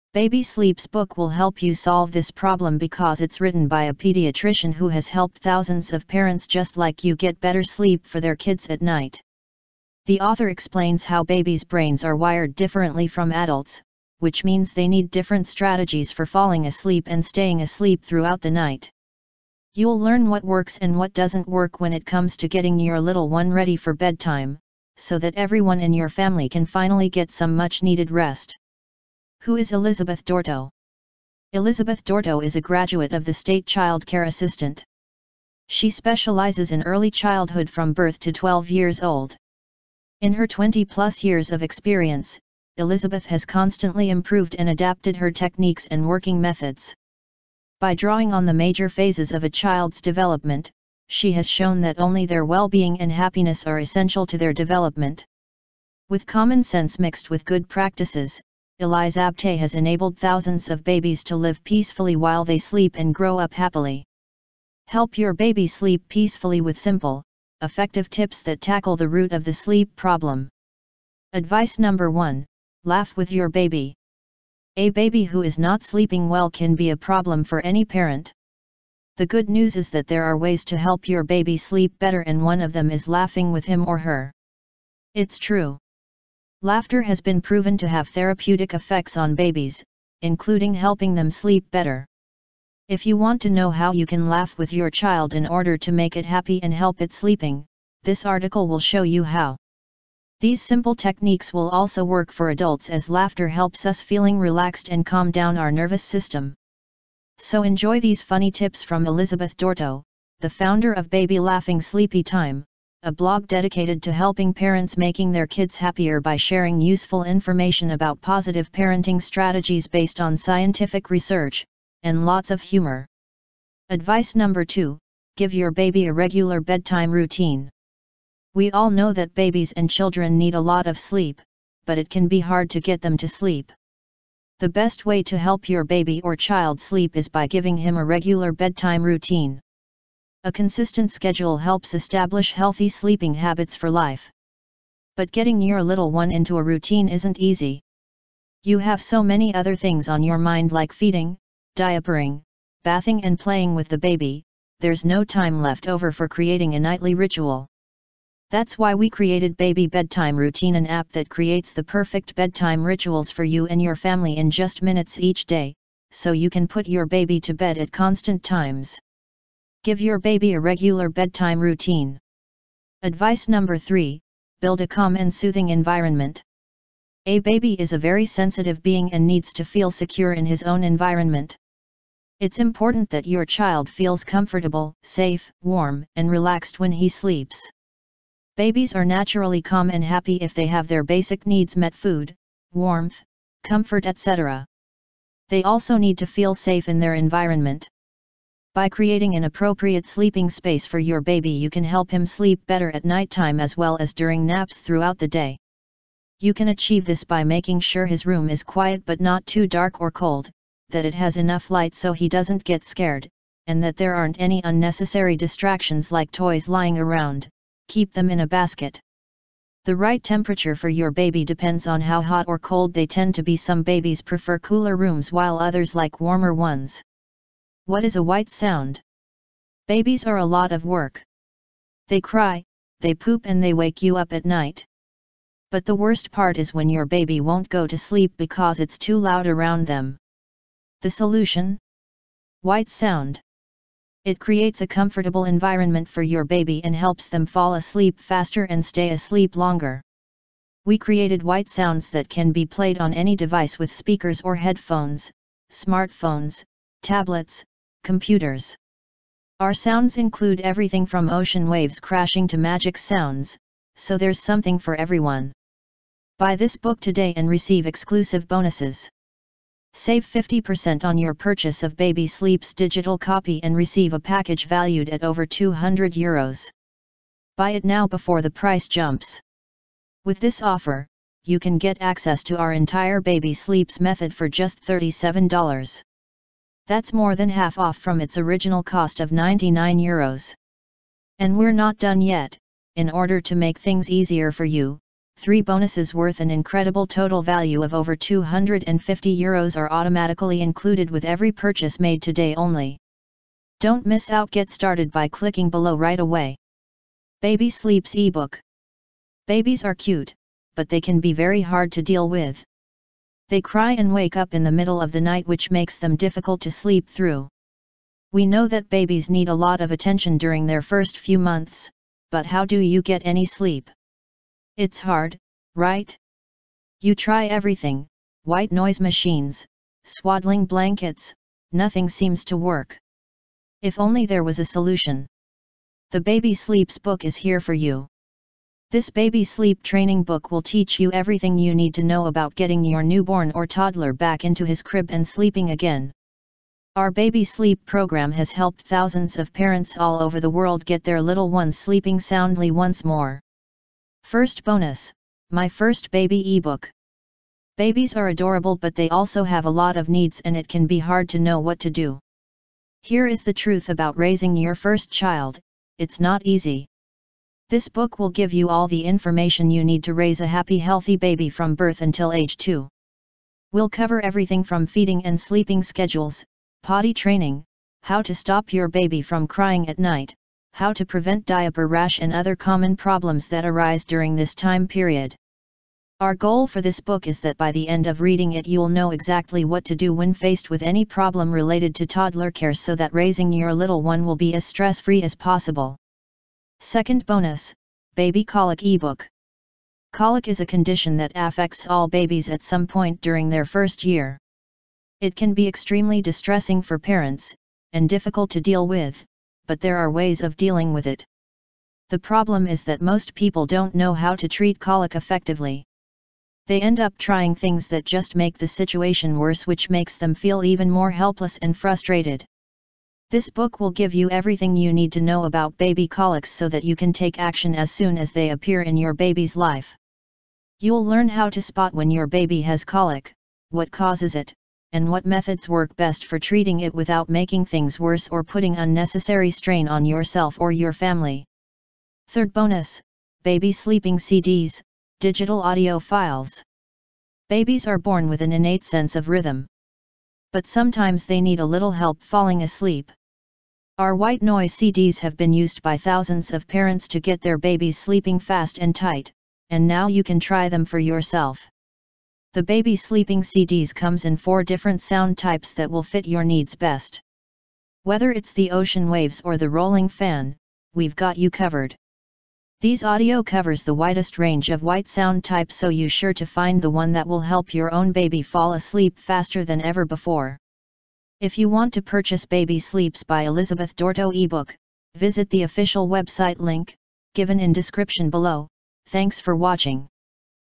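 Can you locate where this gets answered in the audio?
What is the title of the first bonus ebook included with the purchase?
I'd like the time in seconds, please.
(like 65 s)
355 s.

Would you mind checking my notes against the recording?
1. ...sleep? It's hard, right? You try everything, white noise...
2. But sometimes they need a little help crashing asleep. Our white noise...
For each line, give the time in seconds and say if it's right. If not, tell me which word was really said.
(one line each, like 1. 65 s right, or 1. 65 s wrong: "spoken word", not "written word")
1. 323 s right
2. 450 s wrong: "falling", not "crashing".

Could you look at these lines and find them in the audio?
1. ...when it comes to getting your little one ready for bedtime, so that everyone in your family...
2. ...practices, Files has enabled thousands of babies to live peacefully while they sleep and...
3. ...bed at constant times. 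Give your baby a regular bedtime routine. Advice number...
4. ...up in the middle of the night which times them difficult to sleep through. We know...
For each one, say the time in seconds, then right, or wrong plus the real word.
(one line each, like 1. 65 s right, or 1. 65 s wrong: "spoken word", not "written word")
1. 21 s right
2. 57 s wrong: "Elisabeth", not "Files"
3. 167 s right
4. 314 s wrong: "makes", not "times".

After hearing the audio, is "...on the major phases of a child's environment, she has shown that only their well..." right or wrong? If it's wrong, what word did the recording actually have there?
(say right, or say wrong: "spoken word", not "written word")
wrong: "development", not "environment".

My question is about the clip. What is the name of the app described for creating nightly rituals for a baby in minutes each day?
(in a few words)
Baby Bedtime Routine.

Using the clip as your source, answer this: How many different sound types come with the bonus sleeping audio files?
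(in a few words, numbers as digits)
4.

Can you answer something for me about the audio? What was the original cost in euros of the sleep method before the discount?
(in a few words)
99 euros.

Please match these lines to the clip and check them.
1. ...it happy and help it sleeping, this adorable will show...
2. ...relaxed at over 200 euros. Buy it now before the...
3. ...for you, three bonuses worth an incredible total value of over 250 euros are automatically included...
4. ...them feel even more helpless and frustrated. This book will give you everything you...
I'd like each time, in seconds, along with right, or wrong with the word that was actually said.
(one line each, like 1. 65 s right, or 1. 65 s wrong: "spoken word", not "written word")
1. 96 s wrong: "article", not "adorable"
2. 274 s wrong: "valued", not "relaxed"
3. 294 s right
4. 420 s right.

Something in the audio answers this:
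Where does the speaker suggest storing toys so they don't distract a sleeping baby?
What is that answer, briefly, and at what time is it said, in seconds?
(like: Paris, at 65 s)
in a basket, at 218 s.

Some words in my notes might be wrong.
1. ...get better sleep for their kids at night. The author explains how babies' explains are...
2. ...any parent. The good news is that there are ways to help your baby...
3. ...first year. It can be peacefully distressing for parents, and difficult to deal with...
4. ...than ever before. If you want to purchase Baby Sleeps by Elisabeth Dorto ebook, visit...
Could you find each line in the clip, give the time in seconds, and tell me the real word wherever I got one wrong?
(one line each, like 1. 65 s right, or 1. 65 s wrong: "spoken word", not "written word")
1. 7 s wrong: "brains", not "explains"
2. 77 s right
3. 403 s wrong: "extremely", not "peacefully"
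4. 479 s right.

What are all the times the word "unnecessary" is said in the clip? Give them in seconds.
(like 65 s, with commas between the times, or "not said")
214 s, 438 s.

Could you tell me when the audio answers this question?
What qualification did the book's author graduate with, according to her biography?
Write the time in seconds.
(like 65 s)
33 s.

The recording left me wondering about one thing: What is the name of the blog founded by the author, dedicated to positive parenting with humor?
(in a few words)
Baby Laughing Sleepy Time.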